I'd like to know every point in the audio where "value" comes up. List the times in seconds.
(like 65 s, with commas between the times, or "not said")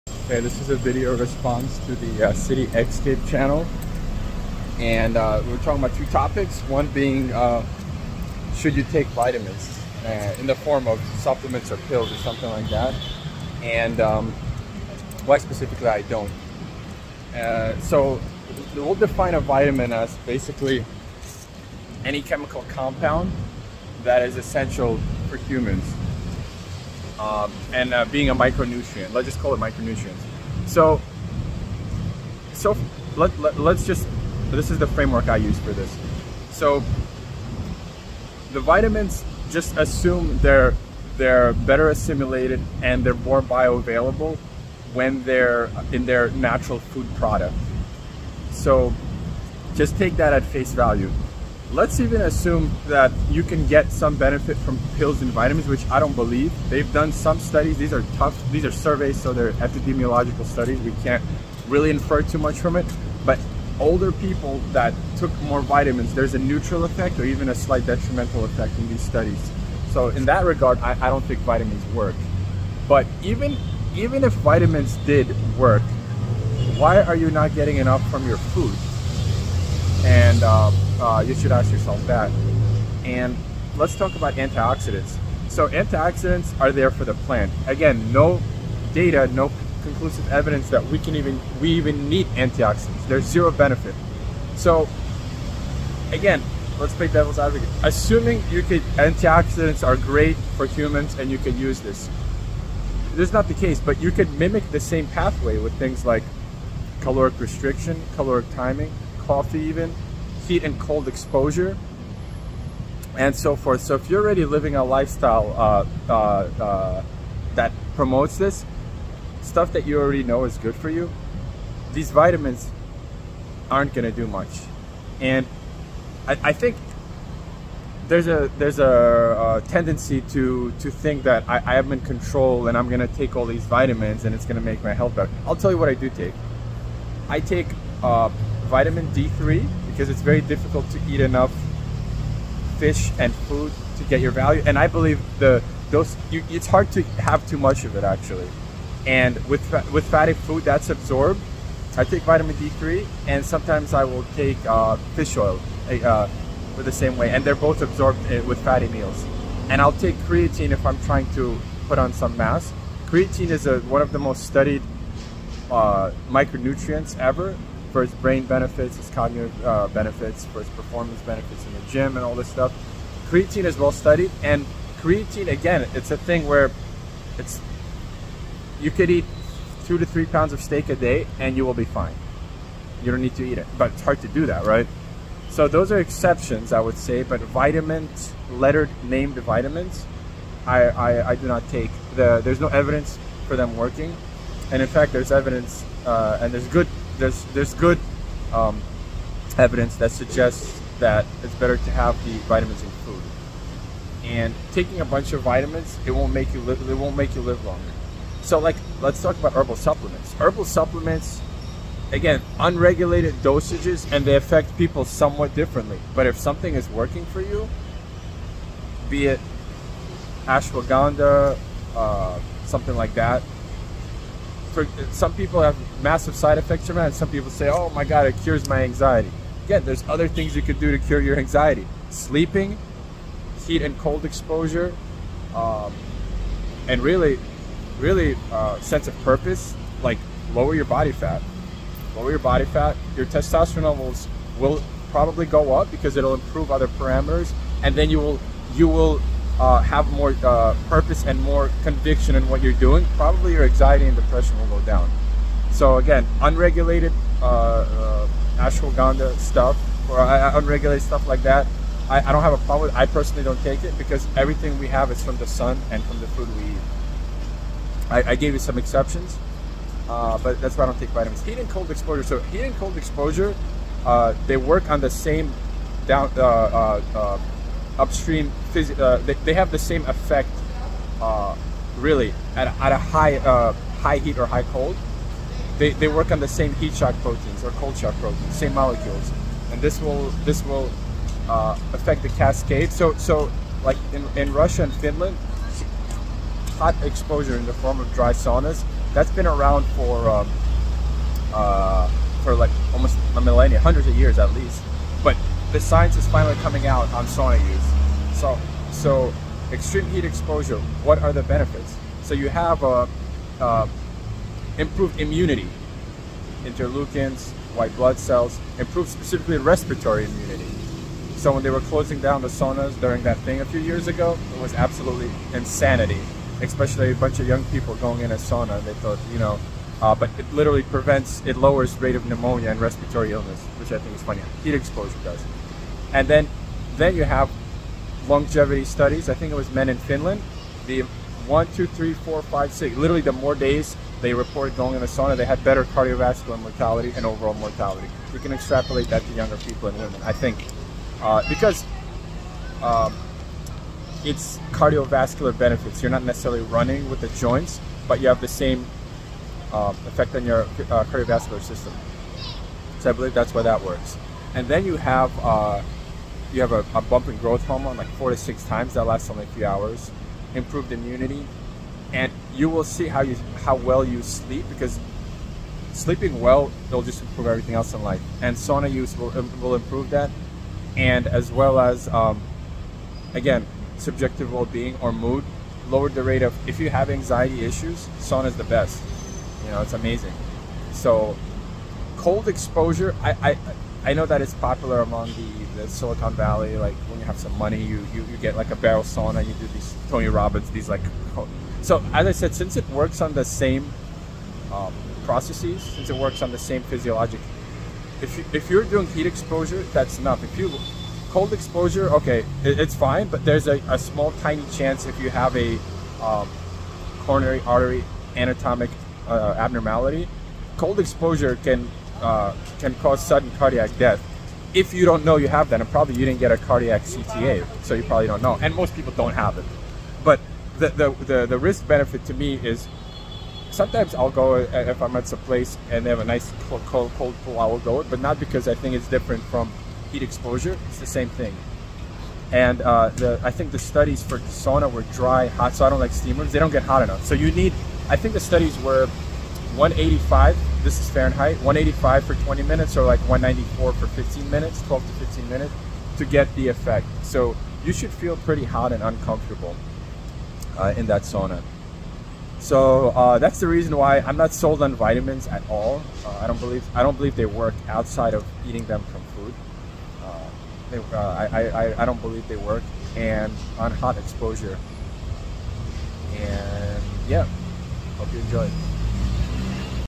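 50 s, 144 s.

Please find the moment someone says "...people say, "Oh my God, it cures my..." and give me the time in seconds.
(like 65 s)
227 s.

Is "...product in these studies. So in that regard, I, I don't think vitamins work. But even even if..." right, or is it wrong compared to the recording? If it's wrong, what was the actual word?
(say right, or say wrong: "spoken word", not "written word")
wrong: "effect", not "product".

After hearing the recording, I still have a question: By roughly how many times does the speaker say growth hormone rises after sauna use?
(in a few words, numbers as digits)
4 to 6 times.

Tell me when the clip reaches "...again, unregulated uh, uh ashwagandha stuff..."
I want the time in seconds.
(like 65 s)
255 s.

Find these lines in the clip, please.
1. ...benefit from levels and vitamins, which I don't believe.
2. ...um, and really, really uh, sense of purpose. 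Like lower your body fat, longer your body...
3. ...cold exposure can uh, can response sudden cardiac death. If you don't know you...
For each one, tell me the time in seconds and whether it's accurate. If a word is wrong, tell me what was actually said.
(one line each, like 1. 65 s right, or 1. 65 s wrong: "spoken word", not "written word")
1. 54 s wrong: "pills", not "levels"
2. 235 s wrong: "lower", not "longer"
3. 420 s wrong: "cause", not "response".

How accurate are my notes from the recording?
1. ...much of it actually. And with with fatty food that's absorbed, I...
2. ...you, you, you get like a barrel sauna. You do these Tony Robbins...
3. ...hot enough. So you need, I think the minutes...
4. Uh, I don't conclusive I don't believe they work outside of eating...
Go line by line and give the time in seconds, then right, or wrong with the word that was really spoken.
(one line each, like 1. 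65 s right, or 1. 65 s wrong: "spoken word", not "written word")
1. 147 s right
2. 397 s right
3. 446 s wrong: "studies", not "minutes"
4. 466 s wrong: "believe", not "conclusive".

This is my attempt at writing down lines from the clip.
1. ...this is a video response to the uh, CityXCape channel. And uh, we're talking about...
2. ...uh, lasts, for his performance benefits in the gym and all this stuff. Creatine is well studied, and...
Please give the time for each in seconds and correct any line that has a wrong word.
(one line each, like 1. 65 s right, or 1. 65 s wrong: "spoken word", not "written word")
1. 0 s right
2. 169 s wrong: "benefits", not "lasts".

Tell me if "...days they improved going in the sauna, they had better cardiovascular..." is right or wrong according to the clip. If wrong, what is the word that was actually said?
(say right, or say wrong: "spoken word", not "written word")
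wrong: "reported", not "improved".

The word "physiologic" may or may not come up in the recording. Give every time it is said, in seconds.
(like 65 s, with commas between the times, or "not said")
406 s.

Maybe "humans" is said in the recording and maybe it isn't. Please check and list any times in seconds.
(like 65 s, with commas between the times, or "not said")
25 s, 100 s.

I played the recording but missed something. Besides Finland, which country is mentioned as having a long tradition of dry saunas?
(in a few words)
Russia.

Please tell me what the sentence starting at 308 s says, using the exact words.
So, so extreme heat exposure, what are the benefits?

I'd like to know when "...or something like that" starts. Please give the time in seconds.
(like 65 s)
12 s.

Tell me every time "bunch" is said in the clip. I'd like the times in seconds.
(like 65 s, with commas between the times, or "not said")
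205 s, 327 s.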